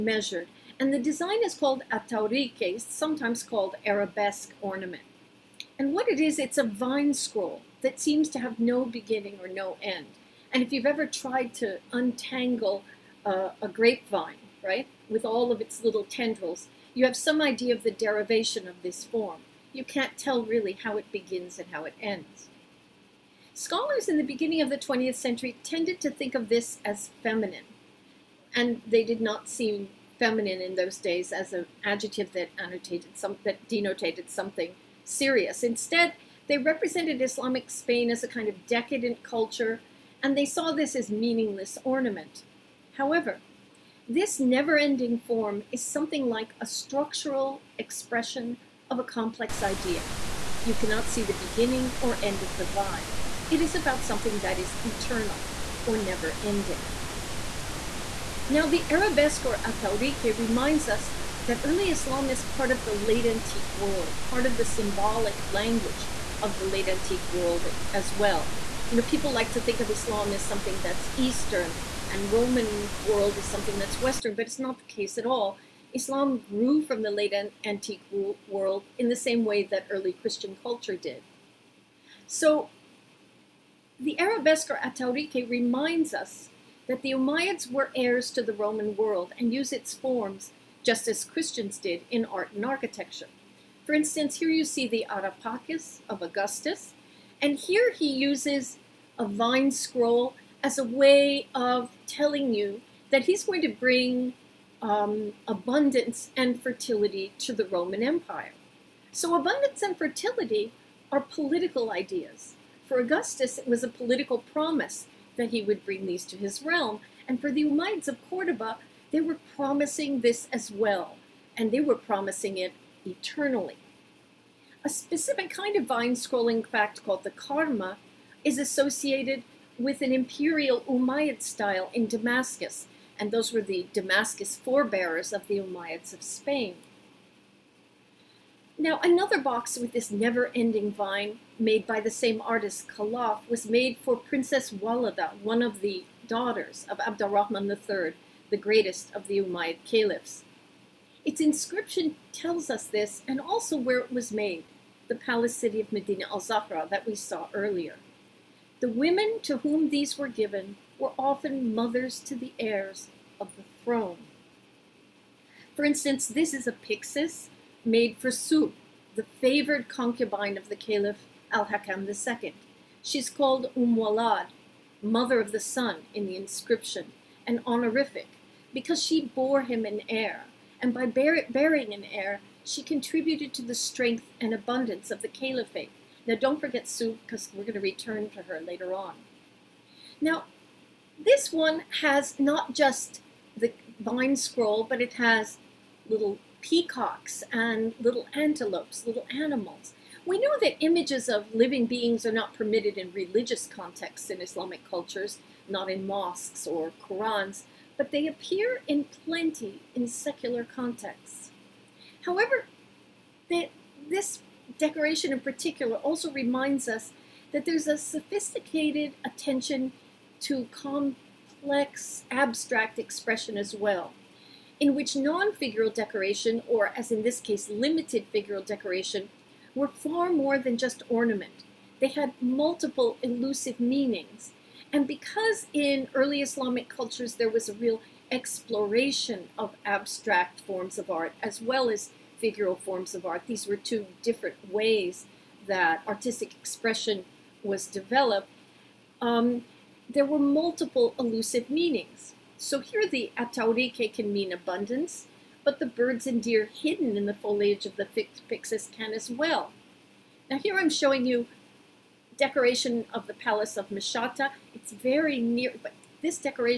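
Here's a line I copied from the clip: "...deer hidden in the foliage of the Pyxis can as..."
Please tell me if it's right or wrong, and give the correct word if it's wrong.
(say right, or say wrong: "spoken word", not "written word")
right.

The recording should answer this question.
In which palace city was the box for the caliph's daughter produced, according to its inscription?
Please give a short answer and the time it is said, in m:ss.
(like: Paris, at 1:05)
Medina al-Zahra, at 2:35.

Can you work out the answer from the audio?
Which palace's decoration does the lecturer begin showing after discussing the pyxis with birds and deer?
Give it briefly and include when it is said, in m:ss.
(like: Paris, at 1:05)
Mshatta, at 4:23.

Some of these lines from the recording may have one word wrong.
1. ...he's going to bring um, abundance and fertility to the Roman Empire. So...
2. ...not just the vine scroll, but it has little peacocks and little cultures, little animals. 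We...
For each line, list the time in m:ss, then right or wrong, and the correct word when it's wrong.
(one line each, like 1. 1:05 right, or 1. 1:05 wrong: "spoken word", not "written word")
1. 1:43 right
2. 3:12 wrong: "antelopes", not "cultures".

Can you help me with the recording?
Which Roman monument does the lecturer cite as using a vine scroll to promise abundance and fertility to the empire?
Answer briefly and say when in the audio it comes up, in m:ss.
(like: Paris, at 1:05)
Ara Pacis of Augustus, at 1:35.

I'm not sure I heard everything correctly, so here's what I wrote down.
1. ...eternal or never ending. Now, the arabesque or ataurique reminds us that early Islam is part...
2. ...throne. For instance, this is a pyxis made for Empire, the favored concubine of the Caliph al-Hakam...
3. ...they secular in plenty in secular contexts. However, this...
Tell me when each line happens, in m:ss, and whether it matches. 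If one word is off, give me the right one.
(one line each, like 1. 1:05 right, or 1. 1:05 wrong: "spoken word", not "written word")
1. 0:54 right
2. 2:43 wrong: "Subh", not "Empire"
3. 3:28 wrong: "appear", not "secular".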